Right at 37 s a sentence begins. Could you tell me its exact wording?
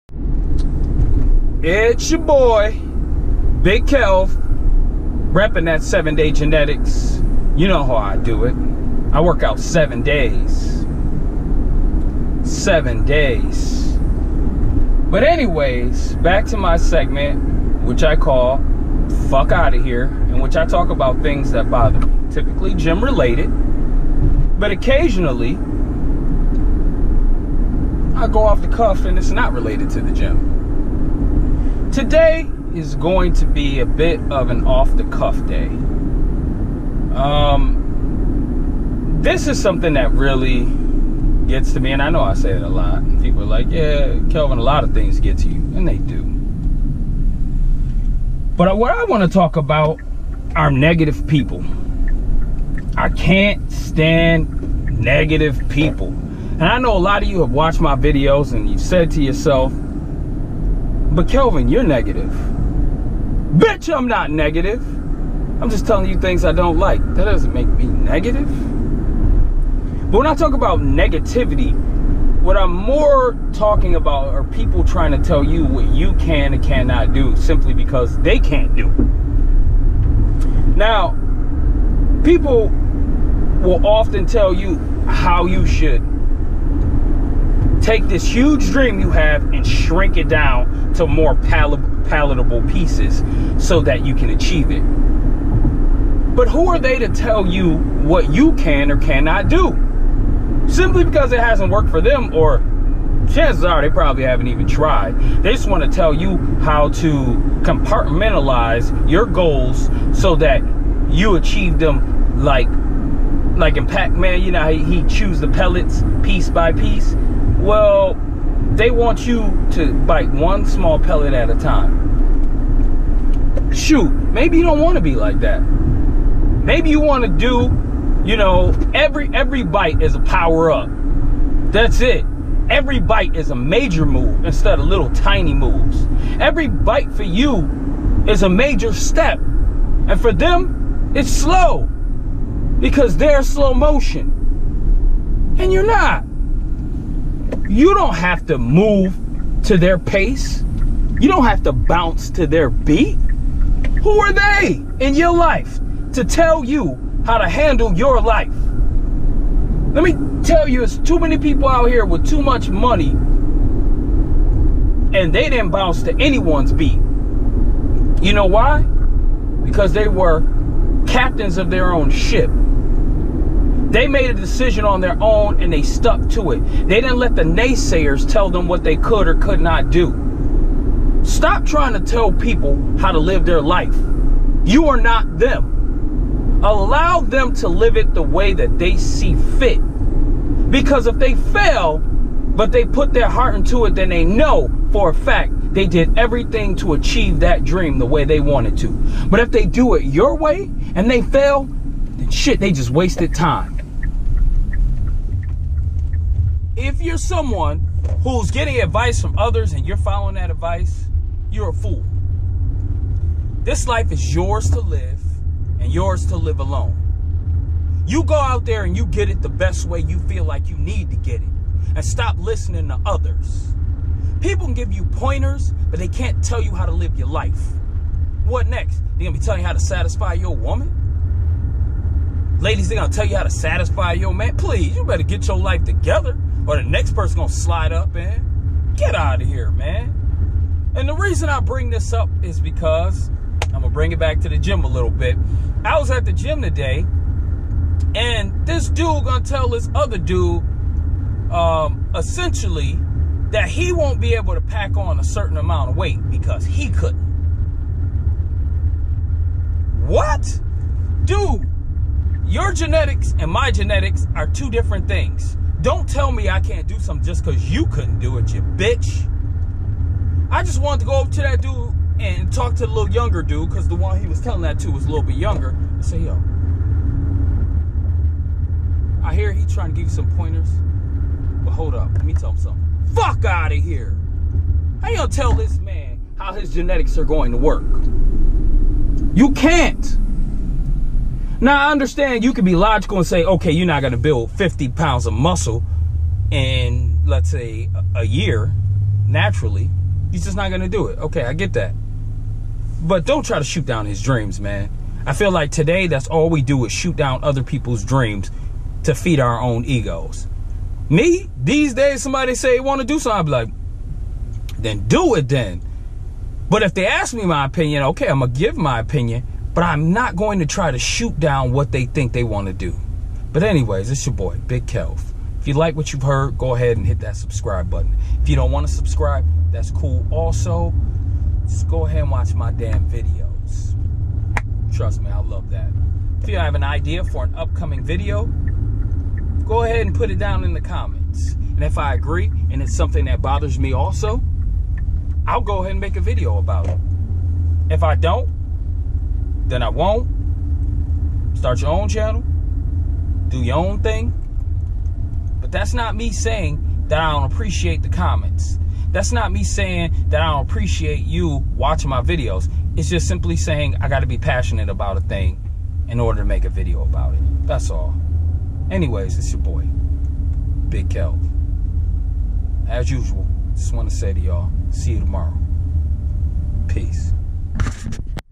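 Um, this is something that really gets to me, and I know I say it a lot.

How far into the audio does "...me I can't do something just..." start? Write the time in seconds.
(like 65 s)
266 s.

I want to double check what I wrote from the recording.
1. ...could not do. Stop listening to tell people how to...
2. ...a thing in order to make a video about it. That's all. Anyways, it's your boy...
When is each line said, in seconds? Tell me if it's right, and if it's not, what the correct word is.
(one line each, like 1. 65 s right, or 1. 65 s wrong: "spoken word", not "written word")
1. 179 s wrong: "trying", not "listening"
2. 365 s right.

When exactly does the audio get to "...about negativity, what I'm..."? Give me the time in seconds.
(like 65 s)
70 s.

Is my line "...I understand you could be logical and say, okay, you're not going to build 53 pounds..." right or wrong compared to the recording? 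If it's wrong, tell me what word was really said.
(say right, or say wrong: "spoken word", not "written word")
wrong: "50", not "53".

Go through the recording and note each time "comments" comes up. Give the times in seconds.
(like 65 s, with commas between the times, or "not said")
340 s, 358 s.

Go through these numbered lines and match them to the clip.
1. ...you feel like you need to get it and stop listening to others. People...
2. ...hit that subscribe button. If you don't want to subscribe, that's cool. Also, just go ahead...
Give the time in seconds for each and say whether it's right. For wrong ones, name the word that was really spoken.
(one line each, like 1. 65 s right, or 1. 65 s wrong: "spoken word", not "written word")
1. 219 s right
2. 327 s right.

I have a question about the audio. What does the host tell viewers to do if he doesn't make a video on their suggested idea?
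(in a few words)
Start your own channel.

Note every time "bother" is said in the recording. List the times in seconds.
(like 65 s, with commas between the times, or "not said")
21 s, 343 s.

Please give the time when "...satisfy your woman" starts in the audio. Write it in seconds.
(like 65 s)
229 s.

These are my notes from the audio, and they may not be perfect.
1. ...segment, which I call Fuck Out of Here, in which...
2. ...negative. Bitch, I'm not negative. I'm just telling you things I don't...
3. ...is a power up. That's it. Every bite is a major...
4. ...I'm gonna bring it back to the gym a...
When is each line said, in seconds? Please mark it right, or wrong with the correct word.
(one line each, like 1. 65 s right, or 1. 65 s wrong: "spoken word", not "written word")
1. 16 s right
2. 61 s right
3. 130 s right
4. 243 s right.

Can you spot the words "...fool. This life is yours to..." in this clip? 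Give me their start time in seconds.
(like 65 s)
211 s.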